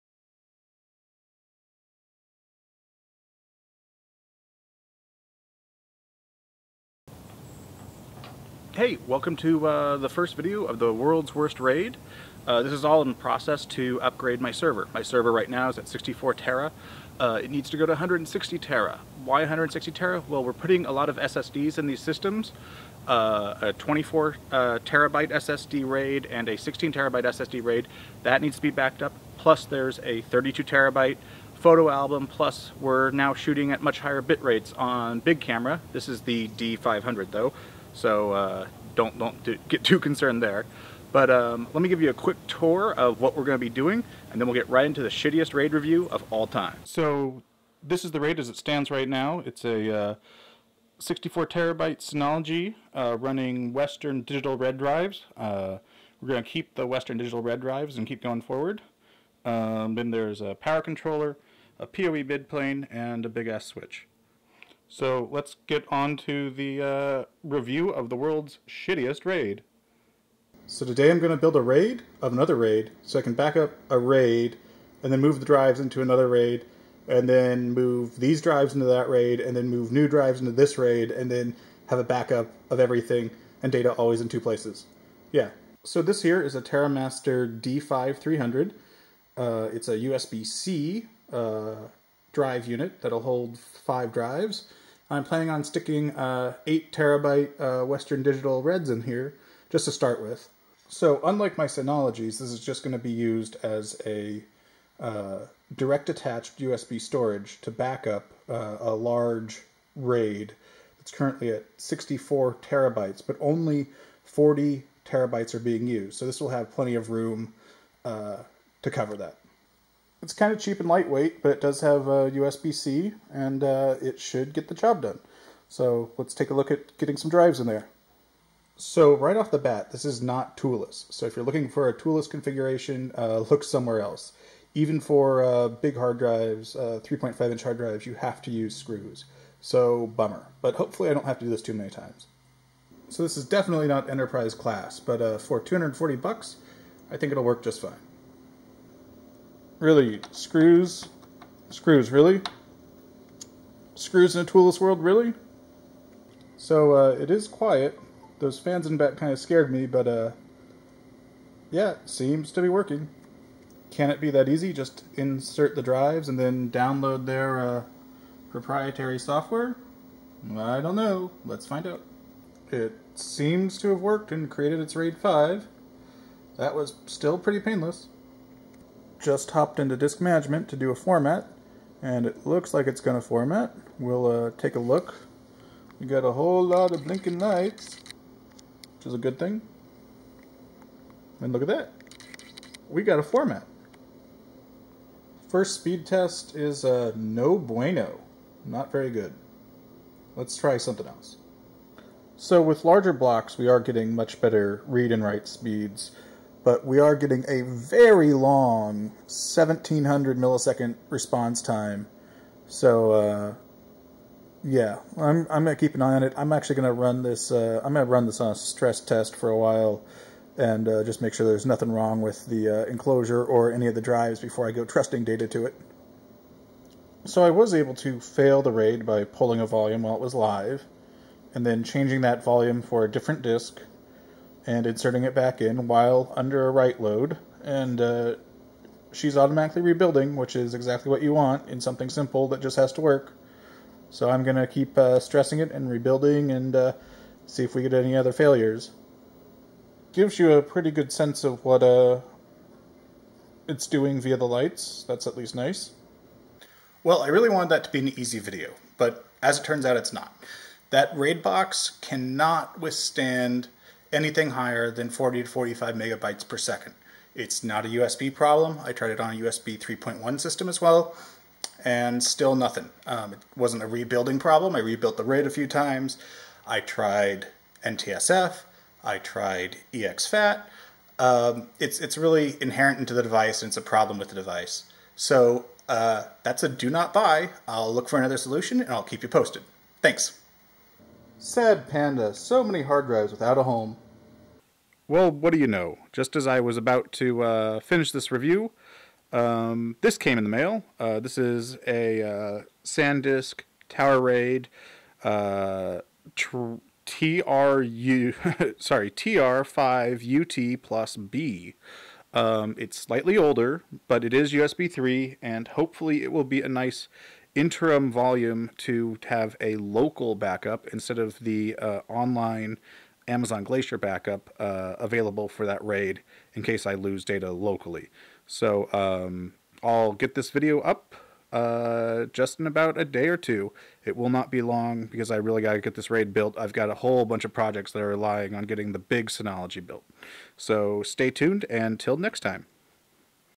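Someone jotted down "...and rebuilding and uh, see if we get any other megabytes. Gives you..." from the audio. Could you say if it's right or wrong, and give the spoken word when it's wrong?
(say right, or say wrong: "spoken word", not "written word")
wrong: "failures", not "megabytes".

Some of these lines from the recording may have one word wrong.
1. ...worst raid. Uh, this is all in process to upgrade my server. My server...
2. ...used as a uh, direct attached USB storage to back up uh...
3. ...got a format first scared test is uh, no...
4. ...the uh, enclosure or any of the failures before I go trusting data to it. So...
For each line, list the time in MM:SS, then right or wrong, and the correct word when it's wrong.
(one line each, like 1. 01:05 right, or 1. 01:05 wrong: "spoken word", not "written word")
1. 00:11 right
2. 01:43 right
3. 03:13 wrong: "speed", not "scared"
4. 03:42 wrong: "drives", not "failures".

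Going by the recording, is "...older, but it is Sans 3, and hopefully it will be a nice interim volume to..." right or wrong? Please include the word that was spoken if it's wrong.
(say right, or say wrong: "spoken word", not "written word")
wrong: "USB", not "Sans".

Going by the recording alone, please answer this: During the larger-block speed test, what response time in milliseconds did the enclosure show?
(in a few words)
1700 milliseconds.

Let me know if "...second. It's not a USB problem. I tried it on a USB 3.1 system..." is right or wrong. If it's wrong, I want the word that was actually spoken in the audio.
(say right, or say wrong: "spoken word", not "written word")
right.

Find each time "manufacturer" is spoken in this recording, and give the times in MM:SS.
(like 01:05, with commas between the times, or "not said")
not said.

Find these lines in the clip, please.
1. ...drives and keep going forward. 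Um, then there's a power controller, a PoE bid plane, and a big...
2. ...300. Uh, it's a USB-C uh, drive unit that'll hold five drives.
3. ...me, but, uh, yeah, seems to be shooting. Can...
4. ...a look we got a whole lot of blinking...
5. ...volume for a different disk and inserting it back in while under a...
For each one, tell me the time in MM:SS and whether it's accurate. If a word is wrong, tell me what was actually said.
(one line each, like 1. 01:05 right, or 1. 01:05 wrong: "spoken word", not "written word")
1. 00:57 right
2. 01:28 right
3. 02:39 wrong: "working", not "shooting"
4. 03:04 right
5. 03:52 right.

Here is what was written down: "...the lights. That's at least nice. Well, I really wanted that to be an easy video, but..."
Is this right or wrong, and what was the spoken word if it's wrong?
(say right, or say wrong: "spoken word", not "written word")
right.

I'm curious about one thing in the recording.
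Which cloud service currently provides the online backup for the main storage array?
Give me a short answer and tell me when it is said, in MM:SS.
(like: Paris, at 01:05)
Amazon Glacier, at 05:23.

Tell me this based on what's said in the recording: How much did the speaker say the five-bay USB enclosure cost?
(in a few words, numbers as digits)
$240.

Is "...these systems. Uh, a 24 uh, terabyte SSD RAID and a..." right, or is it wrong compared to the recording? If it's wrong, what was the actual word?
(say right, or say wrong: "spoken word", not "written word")
right.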